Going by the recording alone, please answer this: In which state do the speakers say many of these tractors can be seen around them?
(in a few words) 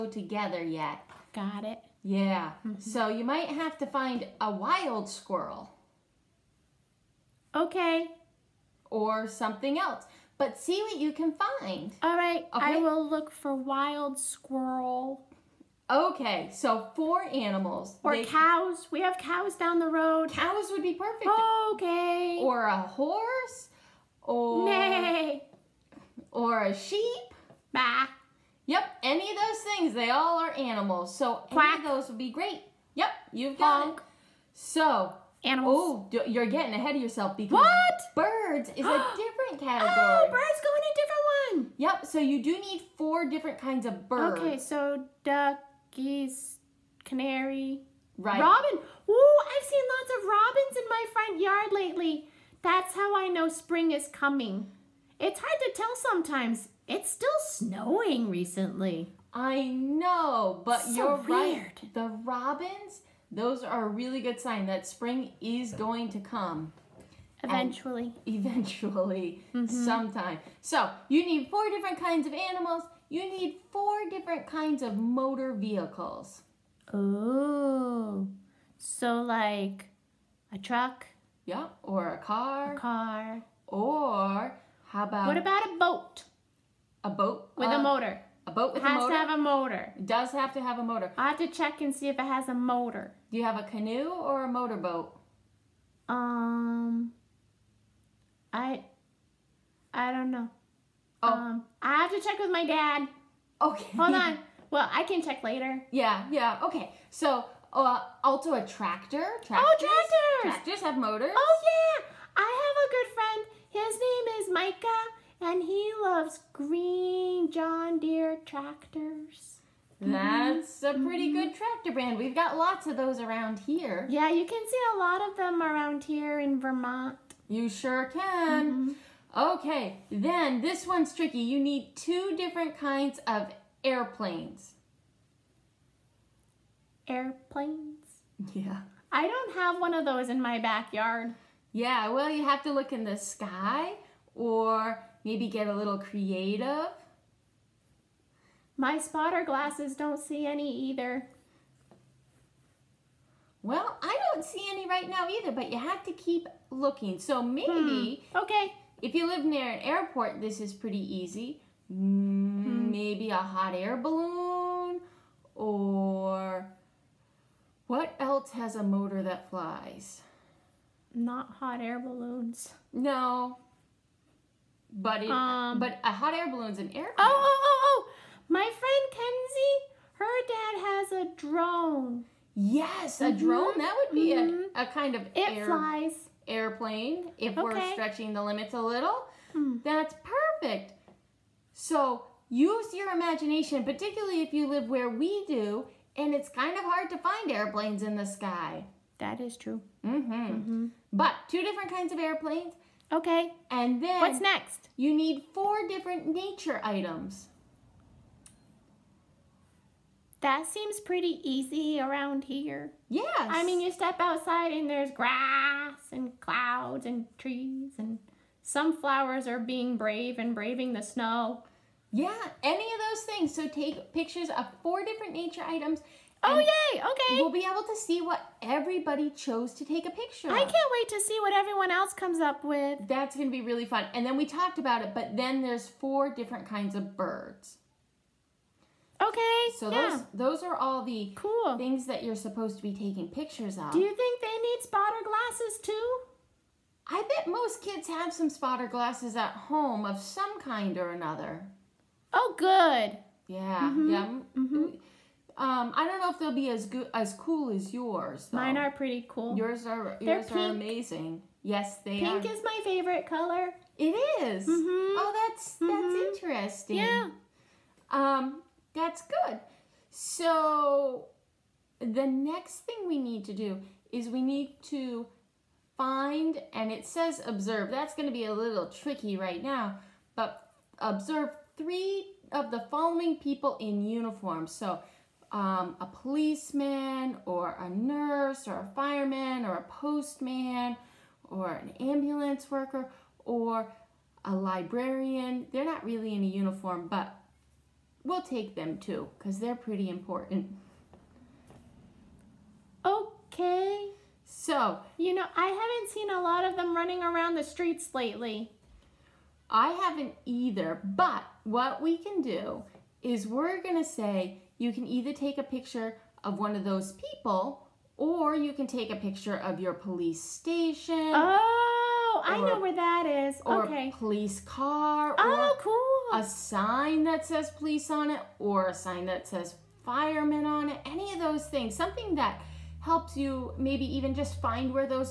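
Vermont.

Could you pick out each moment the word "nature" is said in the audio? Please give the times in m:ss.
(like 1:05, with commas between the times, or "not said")
3:26, 3:45.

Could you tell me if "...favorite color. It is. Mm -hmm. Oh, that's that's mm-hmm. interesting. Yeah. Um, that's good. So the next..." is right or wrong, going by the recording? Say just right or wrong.
right.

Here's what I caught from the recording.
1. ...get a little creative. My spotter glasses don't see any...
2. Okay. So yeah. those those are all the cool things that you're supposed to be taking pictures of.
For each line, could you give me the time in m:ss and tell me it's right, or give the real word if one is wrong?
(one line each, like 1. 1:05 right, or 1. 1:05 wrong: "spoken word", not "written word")
1. 2:25 right
2. 3:59 right.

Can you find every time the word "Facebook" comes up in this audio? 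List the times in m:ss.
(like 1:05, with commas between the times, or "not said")
not said.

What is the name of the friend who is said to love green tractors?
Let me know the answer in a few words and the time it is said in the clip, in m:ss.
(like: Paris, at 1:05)
Micah, at 1:54.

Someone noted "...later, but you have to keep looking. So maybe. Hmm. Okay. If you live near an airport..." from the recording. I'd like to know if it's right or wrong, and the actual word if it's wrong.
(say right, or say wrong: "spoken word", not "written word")
wrong: "either", not "later".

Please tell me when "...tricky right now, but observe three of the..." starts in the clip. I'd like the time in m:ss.
4:38.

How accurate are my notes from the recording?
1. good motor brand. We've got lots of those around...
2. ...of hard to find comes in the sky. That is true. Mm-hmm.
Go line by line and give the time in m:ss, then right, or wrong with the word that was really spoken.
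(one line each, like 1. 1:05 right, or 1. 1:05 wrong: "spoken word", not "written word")
1. 2:01 wrong: "tractor", not "motor"
2. 3:16 wrong: "airplanes", not "comes".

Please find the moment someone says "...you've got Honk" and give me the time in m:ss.
0:33.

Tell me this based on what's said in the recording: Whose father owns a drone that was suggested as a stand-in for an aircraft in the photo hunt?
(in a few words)
Kenzie.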